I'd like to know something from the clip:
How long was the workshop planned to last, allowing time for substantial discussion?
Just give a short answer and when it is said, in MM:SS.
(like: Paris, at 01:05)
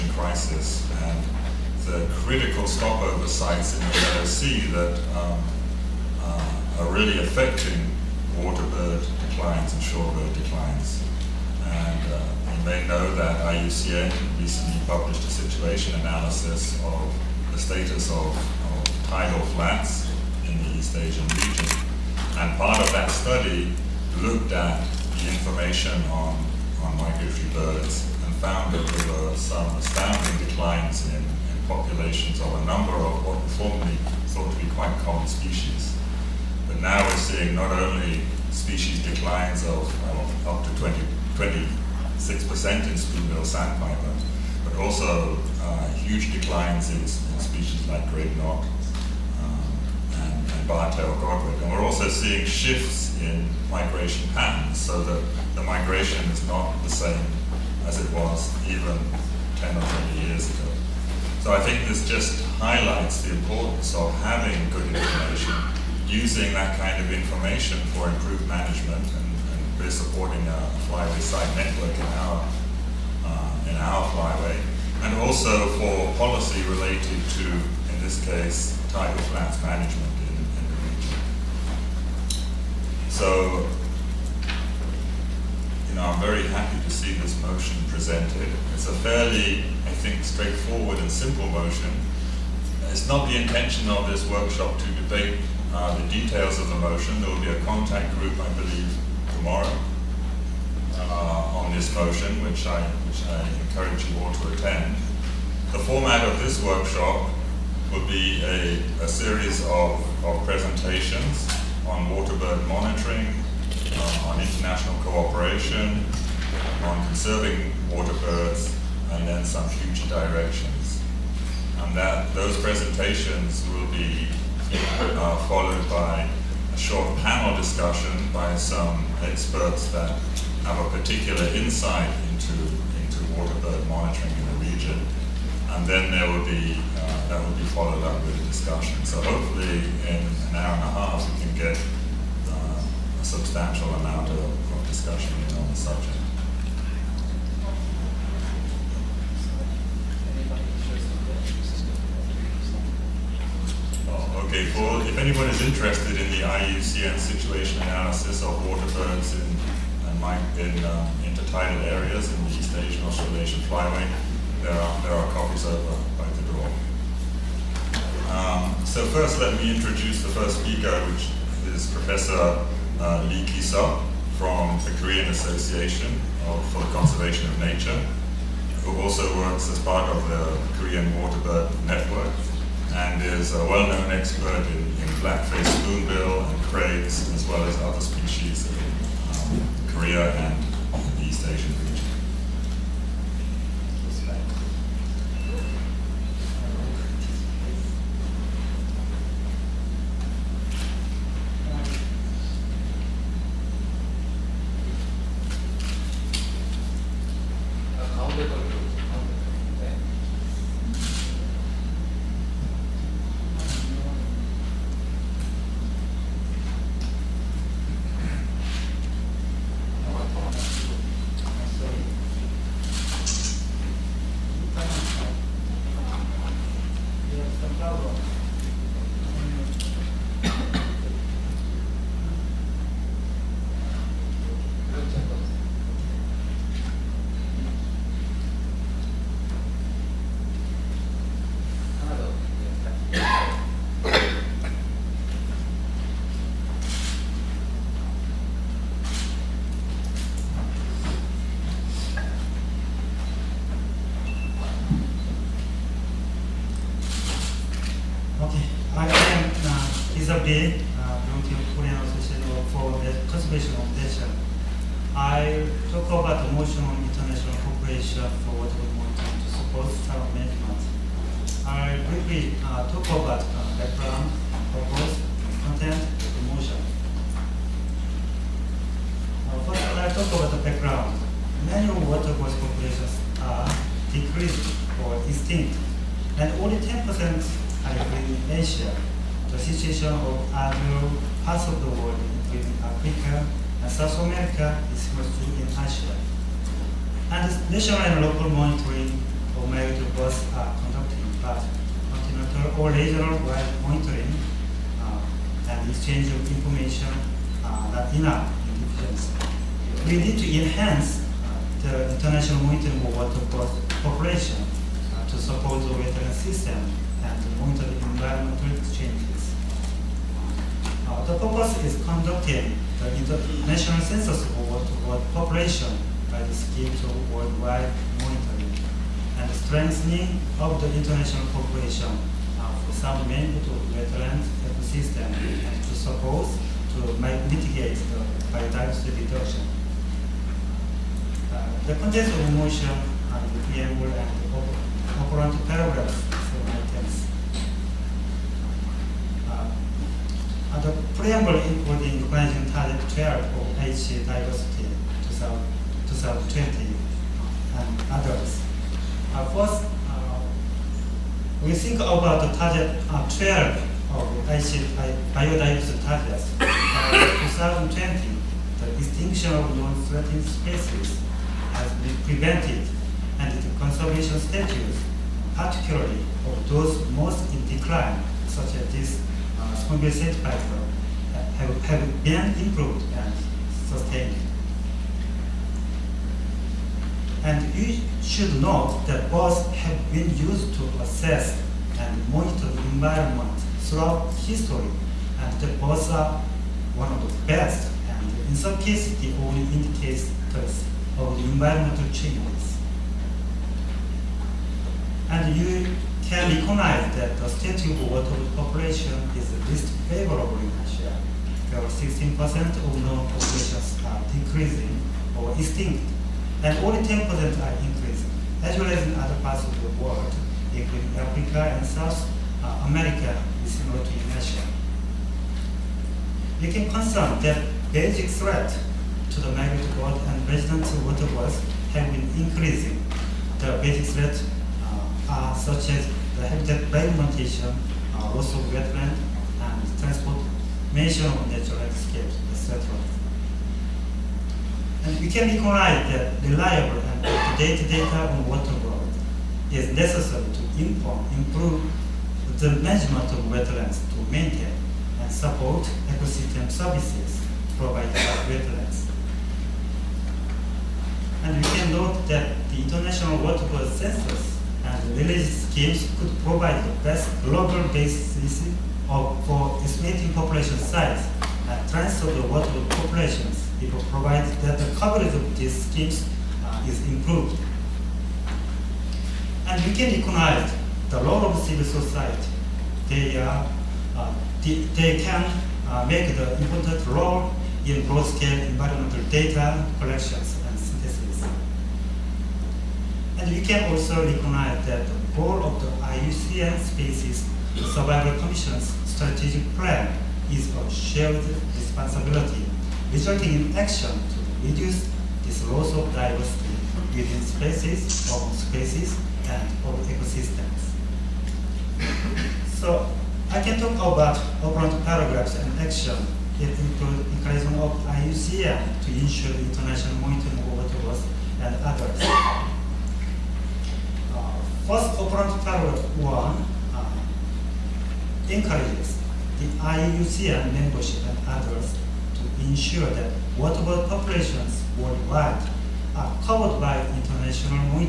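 An hour and a half, at 02:20.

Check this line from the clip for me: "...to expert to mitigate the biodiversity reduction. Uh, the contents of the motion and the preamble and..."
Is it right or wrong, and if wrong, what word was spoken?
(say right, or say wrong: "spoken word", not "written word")
wrong: "support", not "expert".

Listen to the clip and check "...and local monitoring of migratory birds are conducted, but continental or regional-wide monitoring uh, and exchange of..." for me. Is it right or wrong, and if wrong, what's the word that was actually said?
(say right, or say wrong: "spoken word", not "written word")
right.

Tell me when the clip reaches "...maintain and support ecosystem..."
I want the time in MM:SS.
07:34.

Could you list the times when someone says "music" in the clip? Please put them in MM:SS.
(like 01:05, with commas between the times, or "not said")
not said.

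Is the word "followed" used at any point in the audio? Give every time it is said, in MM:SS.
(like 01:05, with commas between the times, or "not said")
02:05, 02:17.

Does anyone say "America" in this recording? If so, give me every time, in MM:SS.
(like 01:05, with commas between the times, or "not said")
04:54, 07:02.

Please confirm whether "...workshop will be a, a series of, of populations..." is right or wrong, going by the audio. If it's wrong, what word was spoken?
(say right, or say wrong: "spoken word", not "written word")
wrong: "presentations", not "populations".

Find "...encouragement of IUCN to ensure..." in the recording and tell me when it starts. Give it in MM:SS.
08:37.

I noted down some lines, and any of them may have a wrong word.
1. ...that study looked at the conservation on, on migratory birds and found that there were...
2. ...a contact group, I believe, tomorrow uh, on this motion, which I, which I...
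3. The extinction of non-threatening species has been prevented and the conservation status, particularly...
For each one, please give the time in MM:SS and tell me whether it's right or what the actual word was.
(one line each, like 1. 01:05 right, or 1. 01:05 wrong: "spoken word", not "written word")
1. 00:22 wrong: "information", not "conservation"
2. 01:37 right
3. 06:08 right.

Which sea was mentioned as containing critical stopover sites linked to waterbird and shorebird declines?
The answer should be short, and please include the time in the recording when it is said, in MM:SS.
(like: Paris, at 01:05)
Red Sea, at 00:04.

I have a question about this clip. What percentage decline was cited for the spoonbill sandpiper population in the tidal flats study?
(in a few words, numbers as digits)
26%.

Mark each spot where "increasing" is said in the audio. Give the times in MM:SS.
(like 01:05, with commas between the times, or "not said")
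06:57, 07:12.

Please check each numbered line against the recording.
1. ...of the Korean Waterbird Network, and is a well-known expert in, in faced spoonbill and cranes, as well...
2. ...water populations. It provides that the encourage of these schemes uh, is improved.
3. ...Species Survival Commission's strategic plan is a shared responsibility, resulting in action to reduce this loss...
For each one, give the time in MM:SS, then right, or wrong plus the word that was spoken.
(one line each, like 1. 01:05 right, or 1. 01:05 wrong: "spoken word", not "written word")
1. 03:00 right
2. 07:52 wrong: "coverage", not "encourage"
3. 08:16 right.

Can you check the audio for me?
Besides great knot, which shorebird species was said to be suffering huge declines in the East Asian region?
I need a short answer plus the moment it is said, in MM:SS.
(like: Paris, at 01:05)
Bar-tailed godwit, at 00:50.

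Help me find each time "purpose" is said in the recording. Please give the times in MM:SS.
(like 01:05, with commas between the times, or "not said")
04:34, 05:21.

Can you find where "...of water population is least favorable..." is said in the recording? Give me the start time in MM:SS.
06:47.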